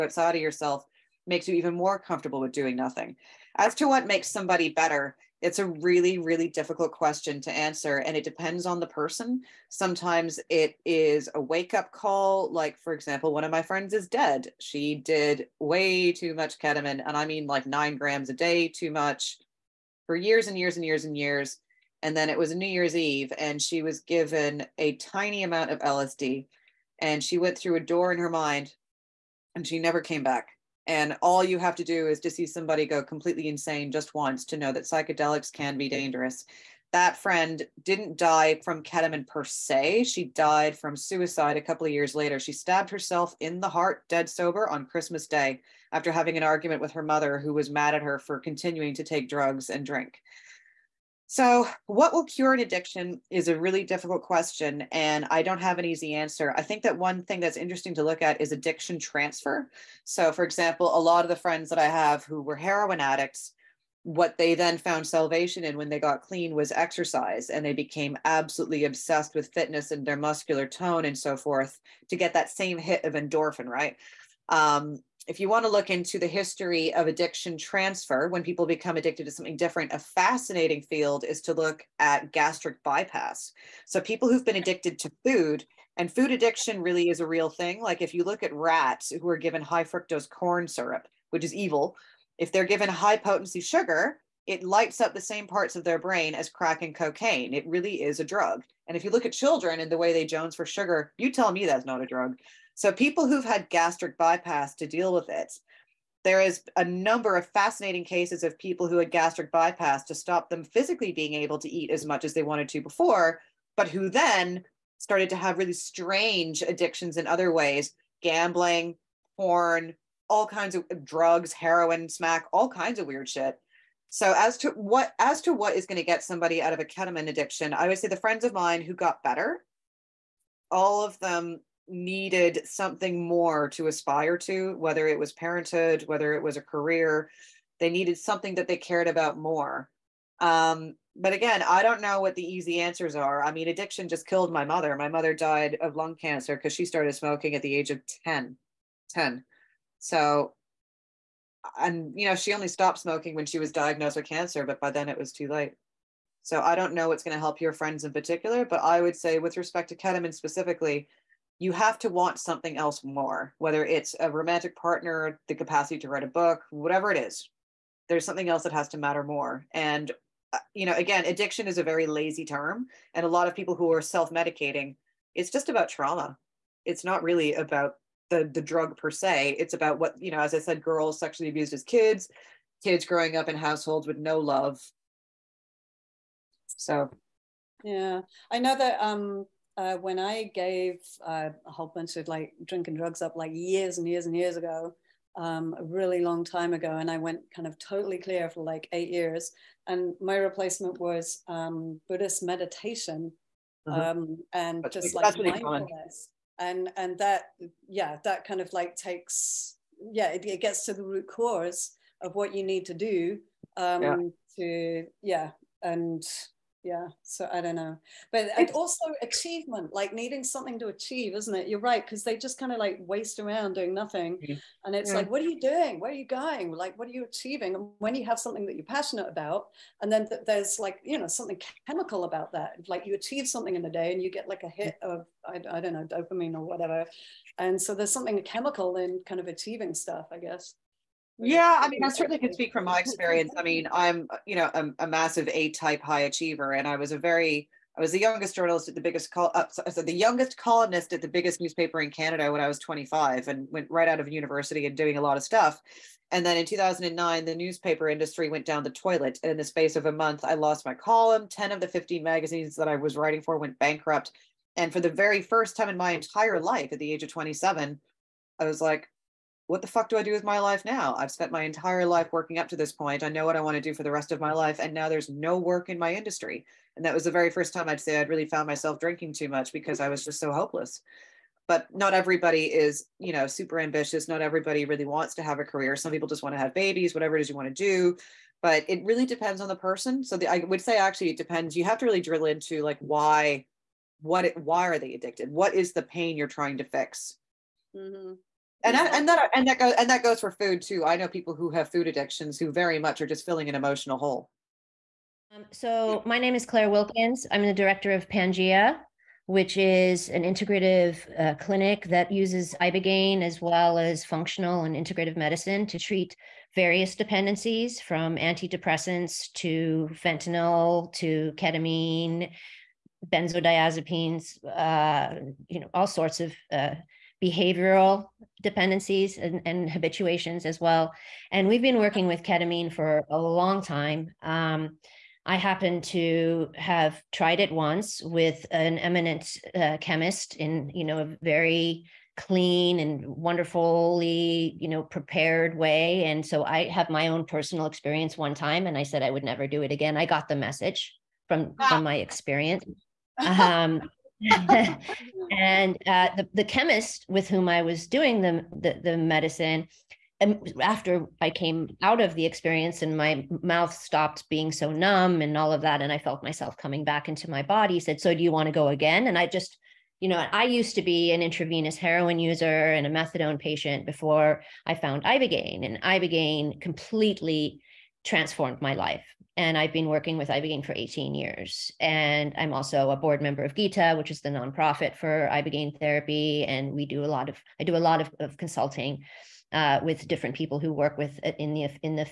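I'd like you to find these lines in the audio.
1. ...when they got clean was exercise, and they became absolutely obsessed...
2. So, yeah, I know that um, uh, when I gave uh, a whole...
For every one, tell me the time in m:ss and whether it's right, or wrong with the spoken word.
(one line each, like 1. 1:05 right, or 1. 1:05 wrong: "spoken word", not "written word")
1. 1:05 right
2. 3:06 right.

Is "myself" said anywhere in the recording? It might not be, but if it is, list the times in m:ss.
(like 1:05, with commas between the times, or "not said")
4:38, 6:06.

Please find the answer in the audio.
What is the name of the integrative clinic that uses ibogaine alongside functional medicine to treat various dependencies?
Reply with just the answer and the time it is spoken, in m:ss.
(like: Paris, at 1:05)
Pangea, at 5:08.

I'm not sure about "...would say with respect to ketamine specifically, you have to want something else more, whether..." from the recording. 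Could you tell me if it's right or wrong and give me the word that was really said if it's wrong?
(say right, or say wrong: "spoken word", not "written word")
right.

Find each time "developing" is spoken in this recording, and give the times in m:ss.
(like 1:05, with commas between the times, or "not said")
not said.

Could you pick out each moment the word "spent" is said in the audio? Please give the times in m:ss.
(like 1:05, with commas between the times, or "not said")
4:31.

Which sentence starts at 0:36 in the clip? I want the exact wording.
That friend didn't die from ketamine per se.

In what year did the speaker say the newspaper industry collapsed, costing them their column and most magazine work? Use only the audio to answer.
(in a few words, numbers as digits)
2009.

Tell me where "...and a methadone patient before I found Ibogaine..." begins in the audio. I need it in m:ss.
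6:12.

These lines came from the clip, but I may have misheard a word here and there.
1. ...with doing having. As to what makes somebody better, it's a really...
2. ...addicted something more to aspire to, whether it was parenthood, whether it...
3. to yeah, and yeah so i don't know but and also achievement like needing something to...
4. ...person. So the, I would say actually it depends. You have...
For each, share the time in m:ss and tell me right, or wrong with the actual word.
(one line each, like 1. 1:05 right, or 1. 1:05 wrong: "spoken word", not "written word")
1. 0:02 wrong: "nothing", not "having"
2. 2:11 wrong: "needed", not "addicted"
3. 3:34 right
4. 4:49 right.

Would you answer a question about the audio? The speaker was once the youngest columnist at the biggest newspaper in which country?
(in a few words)
Canada.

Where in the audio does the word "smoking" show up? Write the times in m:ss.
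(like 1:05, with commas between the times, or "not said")
2:27, 2:32.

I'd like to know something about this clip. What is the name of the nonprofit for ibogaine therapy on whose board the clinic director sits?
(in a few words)
Gita.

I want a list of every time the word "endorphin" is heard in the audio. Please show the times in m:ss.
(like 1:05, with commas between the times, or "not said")
1:13.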